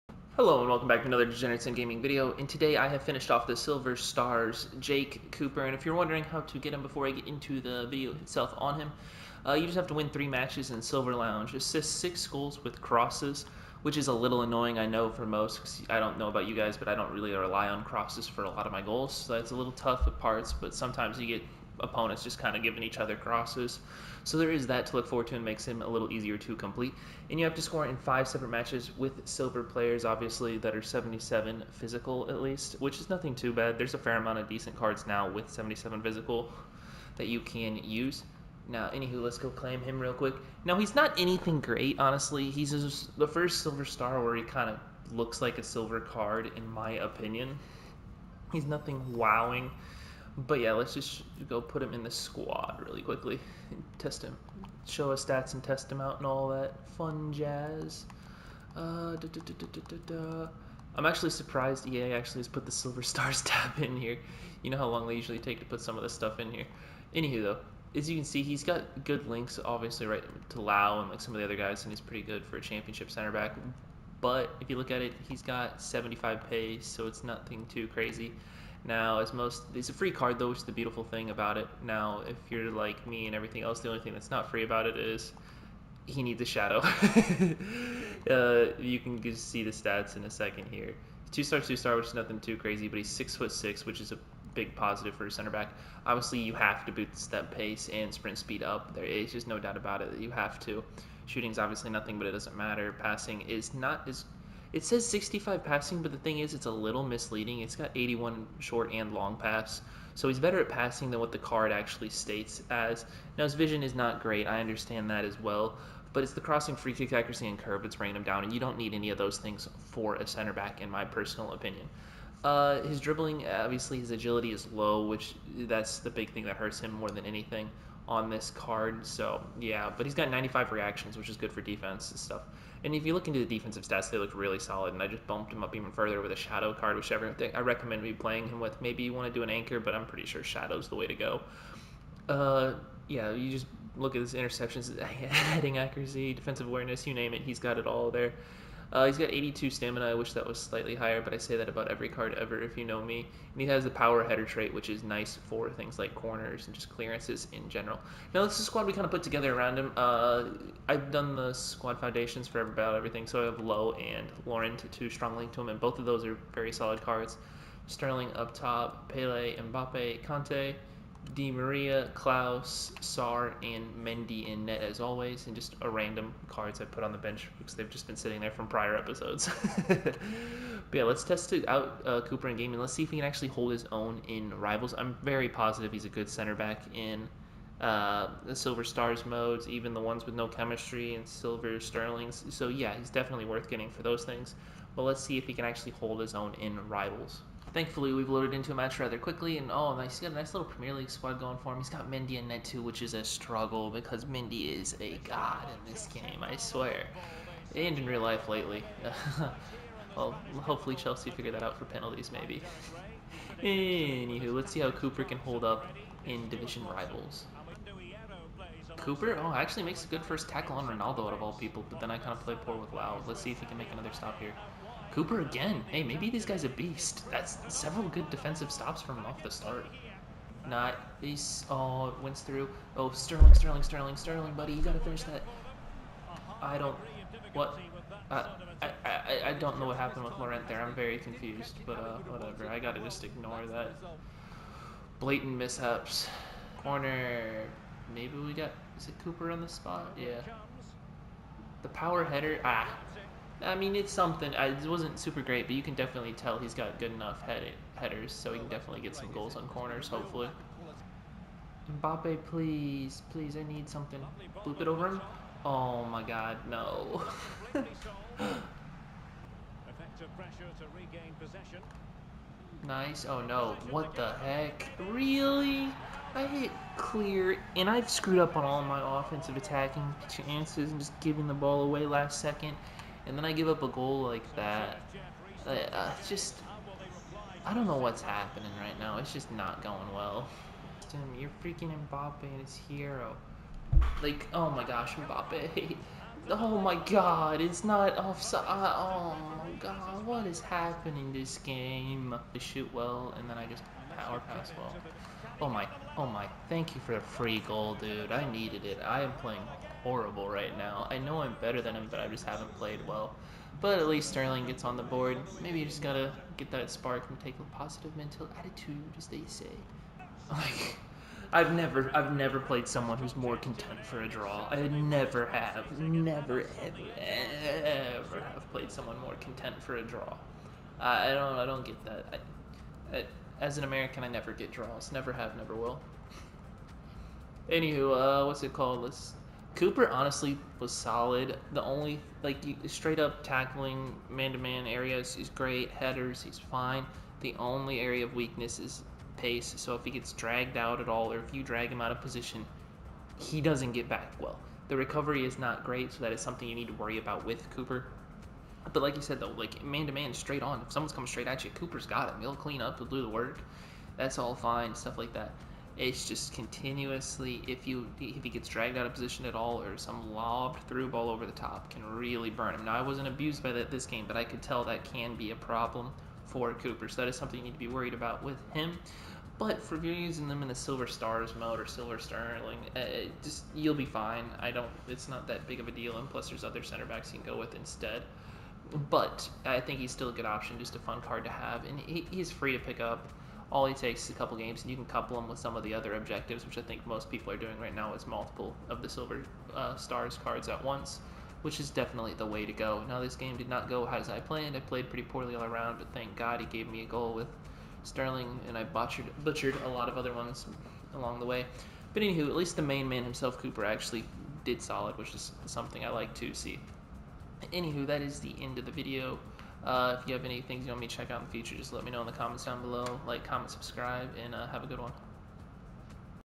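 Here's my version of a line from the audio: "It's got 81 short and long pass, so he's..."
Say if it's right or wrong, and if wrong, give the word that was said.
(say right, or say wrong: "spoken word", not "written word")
right.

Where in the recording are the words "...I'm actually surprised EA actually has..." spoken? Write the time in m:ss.
1:00.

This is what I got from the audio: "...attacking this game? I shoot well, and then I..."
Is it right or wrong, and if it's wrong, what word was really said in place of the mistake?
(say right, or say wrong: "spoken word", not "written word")
wrong: "happening", not "attacking".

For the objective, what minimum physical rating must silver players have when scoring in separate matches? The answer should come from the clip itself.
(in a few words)
77.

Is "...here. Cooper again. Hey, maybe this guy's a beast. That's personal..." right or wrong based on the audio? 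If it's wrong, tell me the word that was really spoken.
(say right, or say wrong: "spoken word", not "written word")
wrong: "several", not "personal".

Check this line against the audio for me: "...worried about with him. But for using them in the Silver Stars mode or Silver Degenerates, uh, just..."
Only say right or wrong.
wrong.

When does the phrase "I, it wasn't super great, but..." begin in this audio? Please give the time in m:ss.
4:14.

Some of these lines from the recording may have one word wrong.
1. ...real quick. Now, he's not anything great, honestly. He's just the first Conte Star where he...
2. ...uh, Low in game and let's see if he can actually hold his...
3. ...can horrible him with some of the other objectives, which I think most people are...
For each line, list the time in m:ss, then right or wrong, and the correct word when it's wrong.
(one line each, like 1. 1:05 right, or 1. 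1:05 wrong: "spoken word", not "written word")
1. 0:39 wrong: "Silver", not "Conte"
2. 3:02 wrong: "Cooper", not "Low"
3. 6:34 wrong: "couple", not "horrible".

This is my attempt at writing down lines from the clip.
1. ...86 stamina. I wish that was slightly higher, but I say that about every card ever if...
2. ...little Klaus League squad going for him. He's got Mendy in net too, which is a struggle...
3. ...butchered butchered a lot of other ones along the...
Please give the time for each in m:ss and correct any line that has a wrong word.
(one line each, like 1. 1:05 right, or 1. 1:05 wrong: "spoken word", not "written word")
1. 2:29 wrong: "82", not "86"
2. 3:20 wrong: "Premier", not "Klaus"
3. 6:48 right.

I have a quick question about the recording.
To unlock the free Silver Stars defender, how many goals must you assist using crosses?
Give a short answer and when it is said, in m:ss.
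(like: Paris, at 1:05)
6, at 0:11.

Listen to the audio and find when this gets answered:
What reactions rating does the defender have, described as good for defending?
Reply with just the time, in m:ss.
2:10.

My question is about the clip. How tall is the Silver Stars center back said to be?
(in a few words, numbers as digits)
6 foot 6.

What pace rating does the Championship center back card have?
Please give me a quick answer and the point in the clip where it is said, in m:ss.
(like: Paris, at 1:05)
75, at 1:15.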